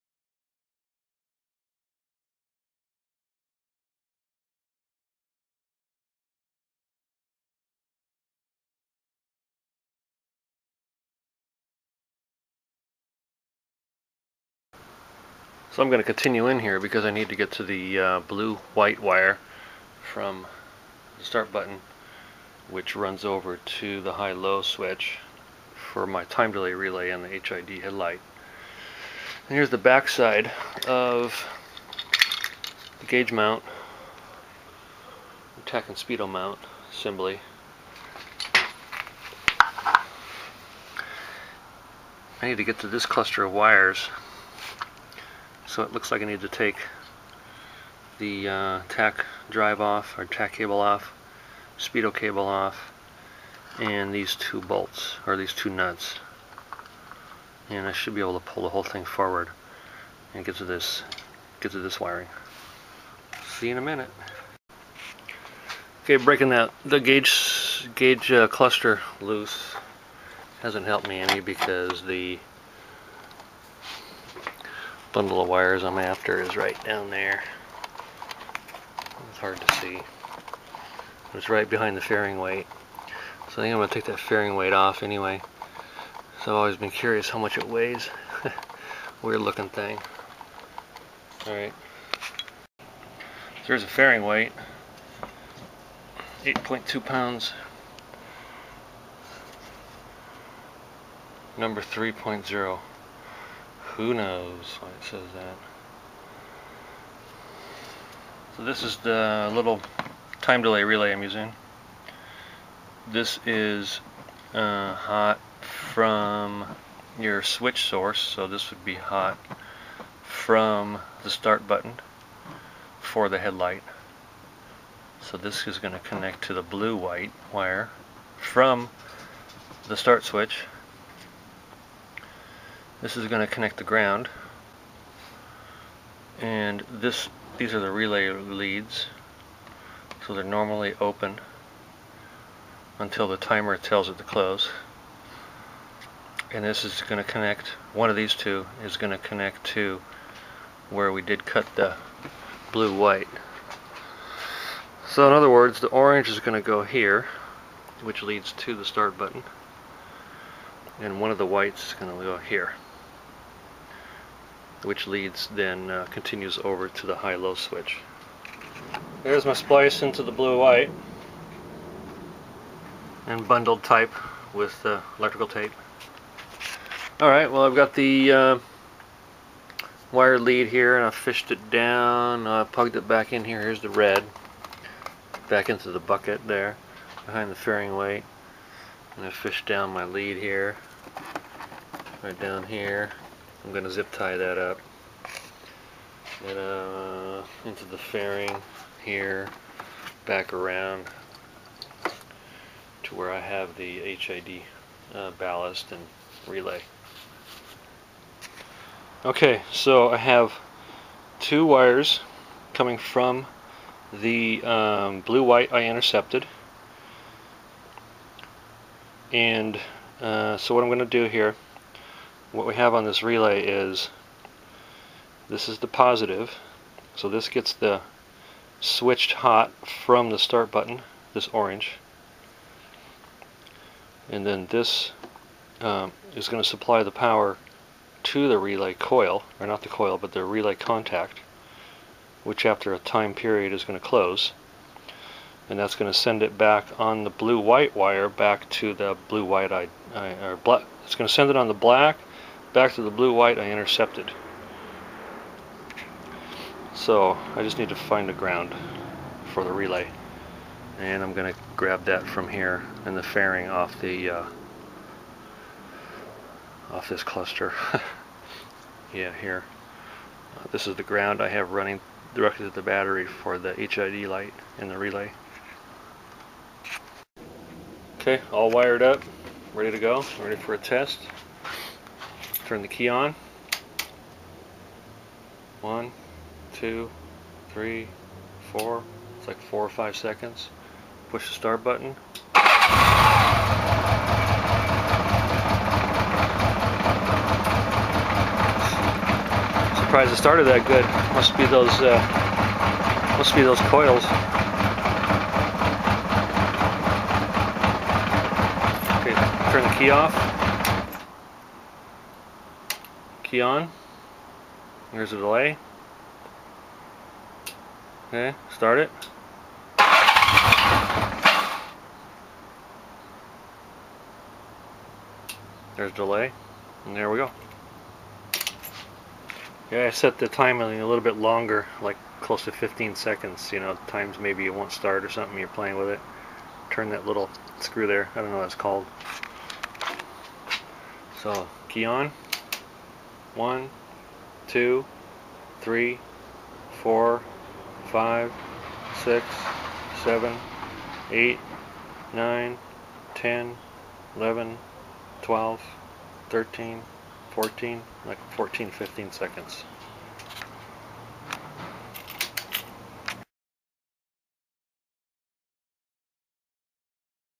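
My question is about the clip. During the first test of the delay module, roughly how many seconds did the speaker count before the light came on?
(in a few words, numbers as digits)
4 or 5 seconds.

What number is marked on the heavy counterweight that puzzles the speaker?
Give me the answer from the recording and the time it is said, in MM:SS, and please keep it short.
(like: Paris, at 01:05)
3.0, at 01:41.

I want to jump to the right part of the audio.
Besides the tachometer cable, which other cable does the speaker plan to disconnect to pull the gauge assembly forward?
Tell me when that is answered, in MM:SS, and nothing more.
00:51.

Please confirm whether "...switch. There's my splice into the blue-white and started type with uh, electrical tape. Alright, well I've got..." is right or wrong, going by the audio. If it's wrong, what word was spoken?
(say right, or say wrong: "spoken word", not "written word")
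wrong: "bundled", not "started".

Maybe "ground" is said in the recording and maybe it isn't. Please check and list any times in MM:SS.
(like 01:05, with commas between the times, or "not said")
02:13, 04:18, 04:31.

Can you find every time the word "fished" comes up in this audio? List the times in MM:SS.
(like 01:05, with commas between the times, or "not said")
03:01, 03:09.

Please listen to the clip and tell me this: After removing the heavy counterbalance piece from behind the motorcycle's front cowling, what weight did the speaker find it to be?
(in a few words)
8.2 pounds.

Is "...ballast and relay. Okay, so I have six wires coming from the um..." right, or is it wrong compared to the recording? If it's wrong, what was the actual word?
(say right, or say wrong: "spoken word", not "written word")
wrong: "two", not "six".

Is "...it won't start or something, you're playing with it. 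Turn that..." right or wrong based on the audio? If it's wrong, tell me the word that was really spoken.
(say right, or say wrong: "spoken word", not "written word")
right.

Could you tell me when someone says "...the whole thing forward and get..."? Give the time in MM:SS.
00:58.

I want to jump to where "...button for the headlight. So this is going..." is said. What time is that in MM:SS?
02:01.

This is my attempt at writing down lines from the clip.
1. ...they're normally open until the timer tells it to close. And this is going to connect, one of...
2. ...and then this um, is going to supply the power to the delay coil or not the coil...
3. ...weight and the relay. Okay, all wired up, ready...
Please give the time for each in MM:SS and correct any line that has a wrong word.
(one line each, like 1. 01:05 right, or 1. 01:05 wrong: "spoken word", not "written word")
1. 02:20 right
2. 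03:54 wrong: "relay", not "delay"
3. 04:34 wrong: "light", not "weight".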